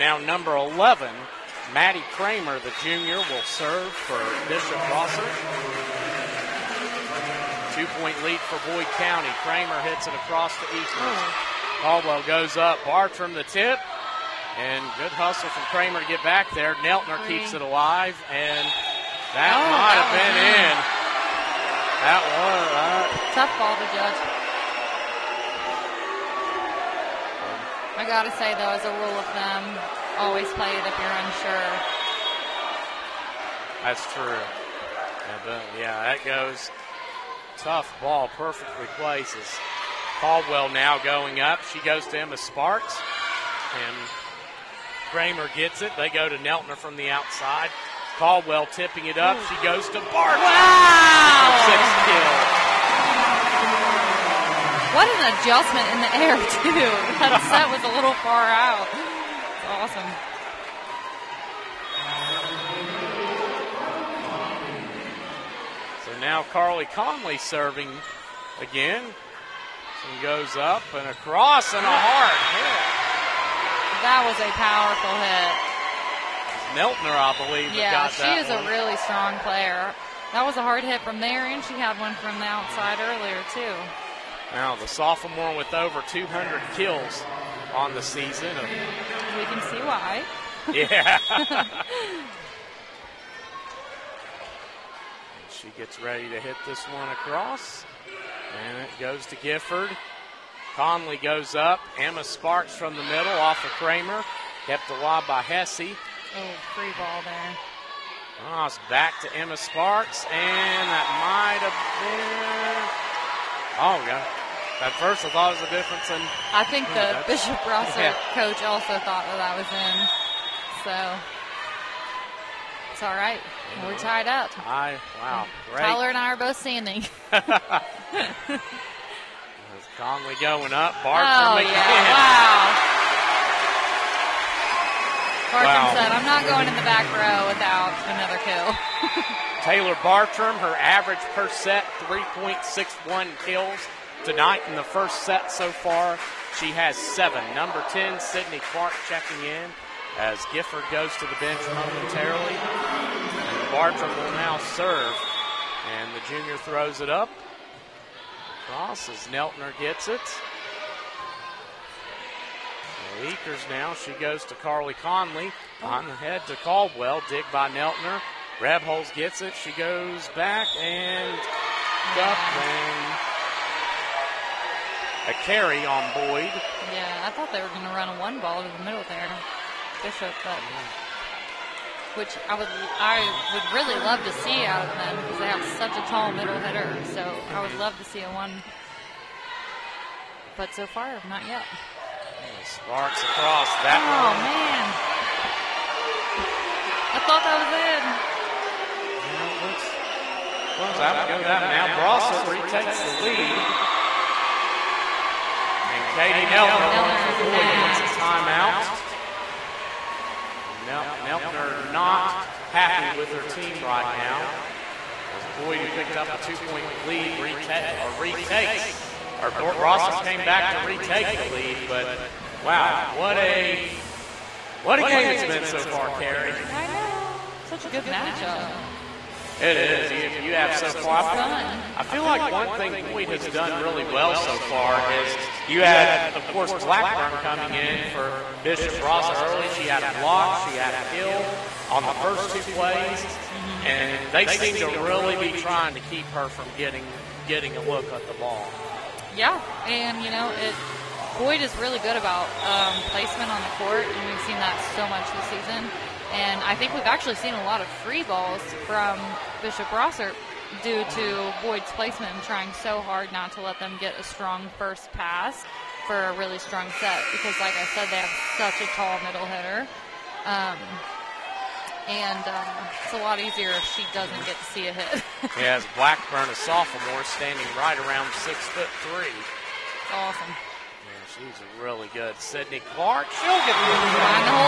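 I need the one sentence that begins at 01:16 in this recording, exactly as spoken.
Neltner, I believe, yeah, she is one.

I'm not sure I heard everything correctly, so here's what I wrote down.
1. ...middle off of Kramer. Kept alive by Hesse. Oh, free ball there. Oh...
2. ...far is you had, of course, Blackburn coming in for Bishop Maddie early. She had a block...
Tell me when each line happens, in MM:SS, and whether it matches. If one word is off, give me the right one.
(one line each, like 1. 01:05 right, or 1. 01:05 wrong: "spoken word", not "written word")
1. 01:43 right
2. 03:54 wrong: "Brossart", not "Maddie".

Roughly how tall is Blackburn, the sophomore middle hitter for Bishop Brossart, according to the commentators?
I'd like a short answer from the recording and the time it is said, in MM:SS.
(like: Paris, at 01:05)
6'3", at 04:38.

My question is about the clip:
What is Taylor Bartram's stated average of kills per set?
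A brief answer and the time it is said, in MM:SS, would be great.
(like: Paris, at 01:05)
3.61, at 02:22.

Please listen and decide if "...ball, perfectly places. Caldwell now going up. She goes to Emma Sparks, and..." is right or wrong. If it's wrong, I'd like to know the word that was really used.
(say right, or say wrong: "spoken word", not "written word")
right.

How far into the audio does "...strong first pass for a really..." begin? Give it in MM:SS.
04:24.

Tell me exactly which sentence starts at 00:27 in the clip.
I gotta say though, as a rule of thumb, always play it if you're unsure.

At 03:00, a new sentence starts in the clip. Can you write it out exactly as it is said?
Bishop, but which I would I would really love to see out of them because they have such a tall middle hitter.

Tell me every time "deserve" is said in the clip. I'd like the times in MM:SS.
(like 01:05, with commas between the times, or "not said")
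not said.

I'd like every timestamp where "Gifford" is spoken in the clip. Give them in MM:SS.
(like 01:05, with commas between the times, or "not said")
01:39, 02:30.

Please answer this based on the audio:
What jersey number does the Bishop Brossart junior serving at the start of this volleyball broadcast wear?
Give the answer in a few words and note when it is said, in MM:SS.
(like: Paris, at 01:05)
11, at 00:00.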